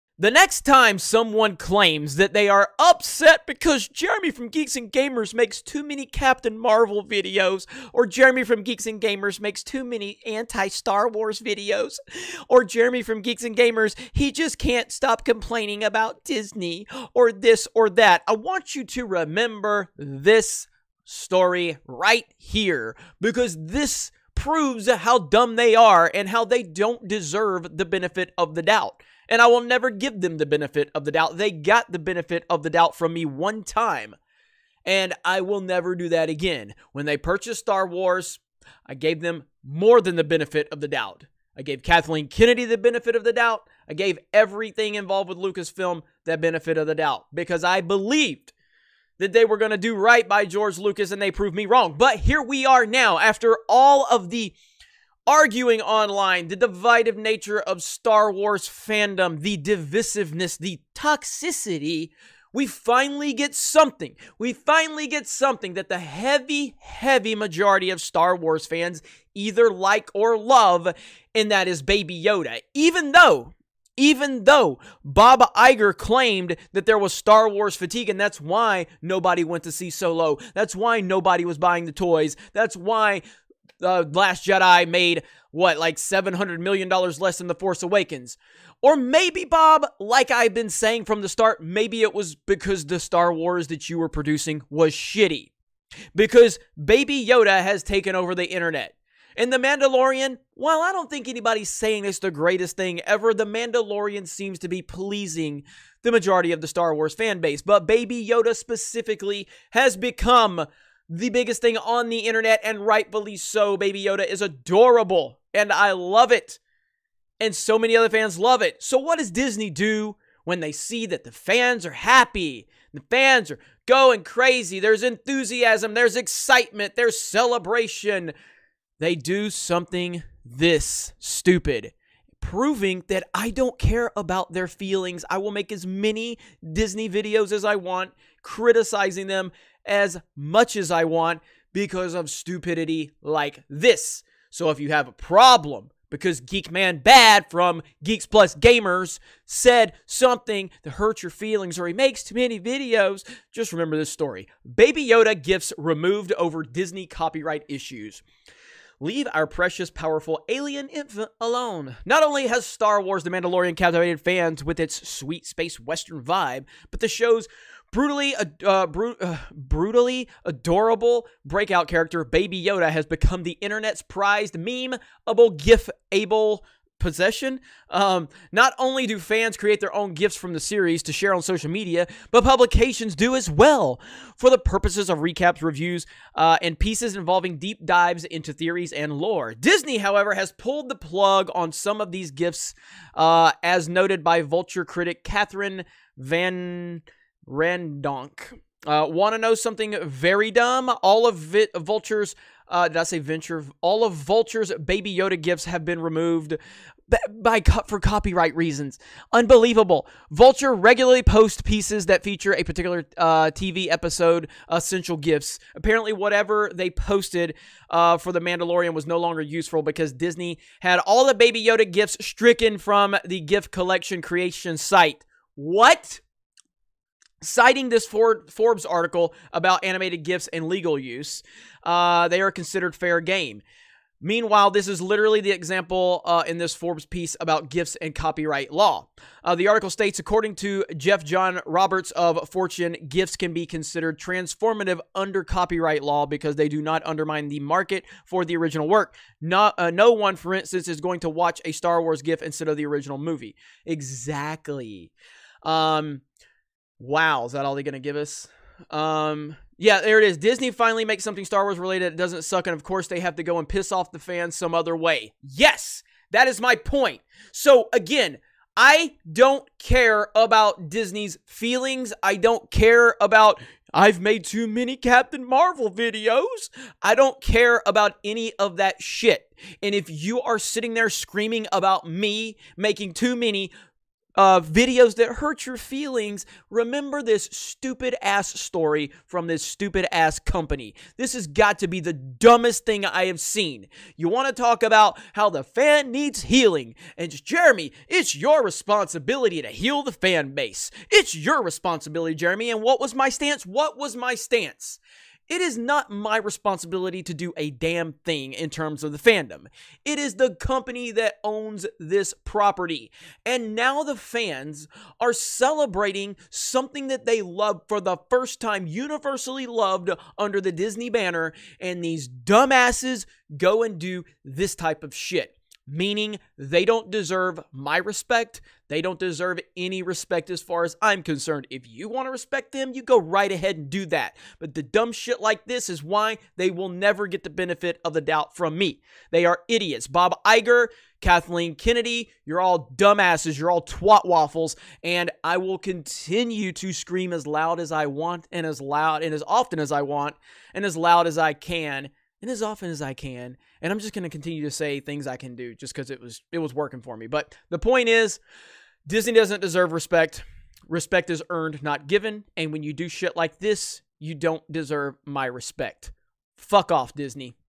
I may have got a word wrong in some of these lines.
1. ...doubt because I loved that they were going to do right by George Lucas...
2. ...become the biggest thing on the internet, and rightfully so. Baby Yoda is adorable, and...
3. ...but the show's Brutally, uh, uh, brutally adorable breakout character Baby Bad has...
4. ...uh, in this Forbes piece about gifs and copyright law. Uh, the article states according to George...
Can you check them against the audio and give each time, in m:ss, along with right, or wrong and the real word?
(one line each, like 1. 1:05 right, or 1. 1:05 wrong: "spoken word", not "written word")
1. 0:46 wrong: "believed", not "loved"
2. 1:49 right
3. 2:46 wrong: "Yoda", not "Bad"
4. 3:56 wrong: "Jeff", not "George".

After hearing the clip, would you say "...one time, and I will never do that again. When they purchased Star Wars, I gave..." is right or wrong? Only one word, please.
right.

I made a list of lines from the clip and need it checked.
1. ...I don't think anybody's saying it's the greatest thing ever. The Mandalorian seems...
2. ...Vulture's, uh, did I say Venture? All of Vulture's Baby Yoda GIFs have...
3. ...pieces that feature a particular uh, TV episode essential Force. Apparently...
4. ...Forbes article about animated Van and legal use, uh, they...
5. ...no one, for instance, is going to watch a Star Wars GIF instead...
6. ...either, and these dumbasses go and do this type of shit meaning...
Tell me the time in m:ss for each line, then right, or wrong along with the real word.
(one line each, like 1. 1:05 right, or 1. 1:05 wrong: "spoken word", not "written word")
1. 1:40 right
2. 3:21 right
3. 3:31 wrong: "GIFs", not "Force"
4. 3:48 wrong: "GIFs", not "Van"
5. 4:09 right
6. 5:21 wrong: "banner", not "either".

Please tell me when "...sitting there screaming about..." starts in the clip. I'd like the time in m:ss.
4:40.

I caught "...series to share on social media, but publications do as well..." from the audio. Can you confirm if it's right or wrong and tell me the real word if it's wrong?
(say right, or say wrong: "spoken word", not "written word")
right.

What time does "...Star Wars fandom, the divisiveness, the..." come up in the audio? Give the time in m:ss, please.
0:57.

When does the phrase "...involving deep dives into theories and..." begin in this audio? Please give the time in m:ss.
3:07.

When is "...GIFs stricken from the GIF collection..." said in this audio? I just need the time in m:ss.
3:41.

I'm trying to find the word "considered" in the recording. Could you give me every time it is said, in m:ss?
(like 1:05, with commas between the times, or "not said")
3:52, 4:03.